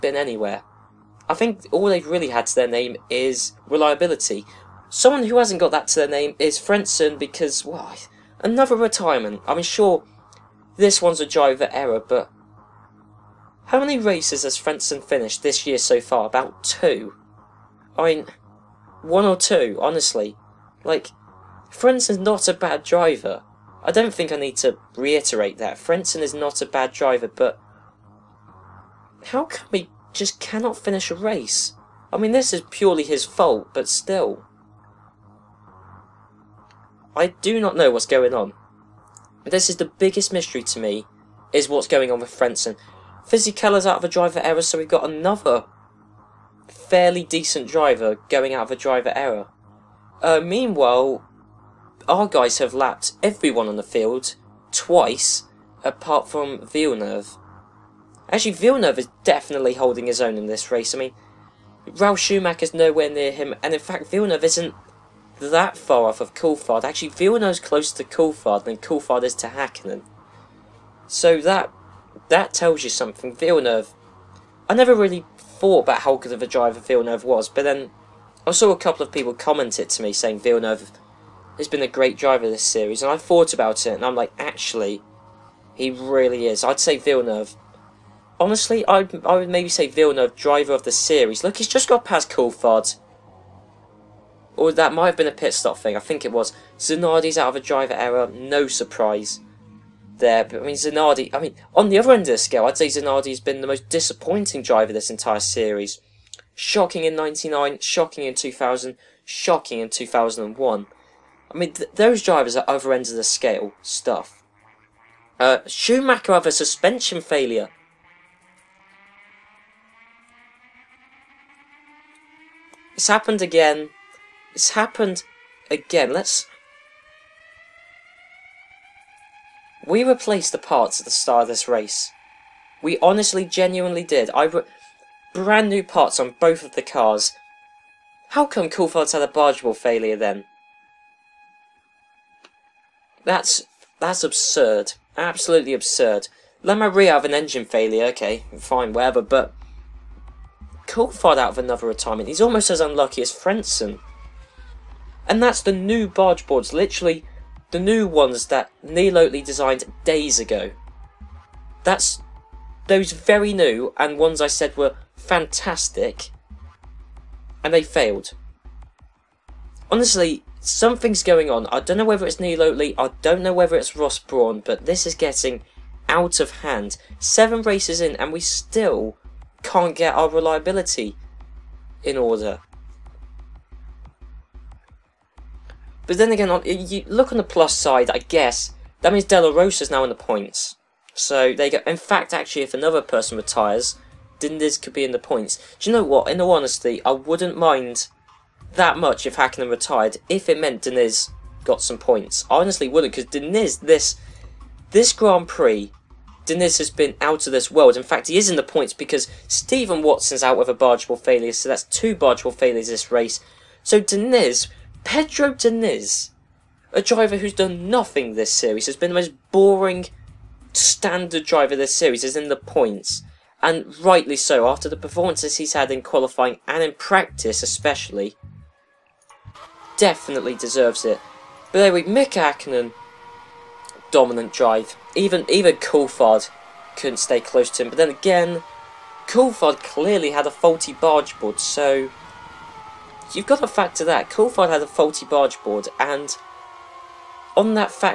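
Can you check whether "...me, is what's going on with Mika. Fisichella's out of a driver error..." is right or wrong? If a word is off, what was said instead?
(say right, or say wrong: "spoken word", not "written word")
wrong: "Frentzen", not "Mika".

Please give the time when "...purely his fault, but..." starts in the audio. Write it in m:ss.
0:32.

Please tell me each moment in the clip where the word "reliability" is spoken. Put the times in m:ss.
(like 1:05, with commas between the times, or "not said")
0:03, 3:00.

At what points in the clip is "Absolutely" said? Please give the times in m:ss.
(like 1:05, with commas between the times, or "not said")
2:25.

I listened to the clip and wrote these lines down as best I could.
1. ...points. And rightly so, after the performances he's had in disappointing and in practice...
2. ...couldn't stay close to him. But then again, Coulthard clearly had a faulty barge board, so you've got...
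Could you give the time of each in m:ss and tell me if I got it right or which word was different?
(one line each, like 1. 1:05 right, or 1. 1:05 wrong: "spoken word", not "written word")
1. 3:42 wrong: "qualifying", not "disappointing"
2. 3:56 right.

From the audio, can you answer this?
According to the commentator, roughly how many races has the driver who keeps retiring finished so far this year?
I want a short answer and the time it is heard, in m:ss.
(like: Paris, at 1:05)
2, at 0:16.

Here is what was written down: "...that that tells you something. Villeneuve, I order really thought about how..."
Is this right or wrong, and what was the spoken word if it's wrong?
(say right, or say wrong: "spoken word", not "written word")
wrong: "never", not "order".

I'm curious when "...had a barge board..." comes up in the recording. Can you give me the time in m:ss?
2:19.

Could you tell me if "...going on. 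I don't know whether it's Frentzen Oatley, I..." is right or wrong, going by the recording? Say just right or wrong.
wrong.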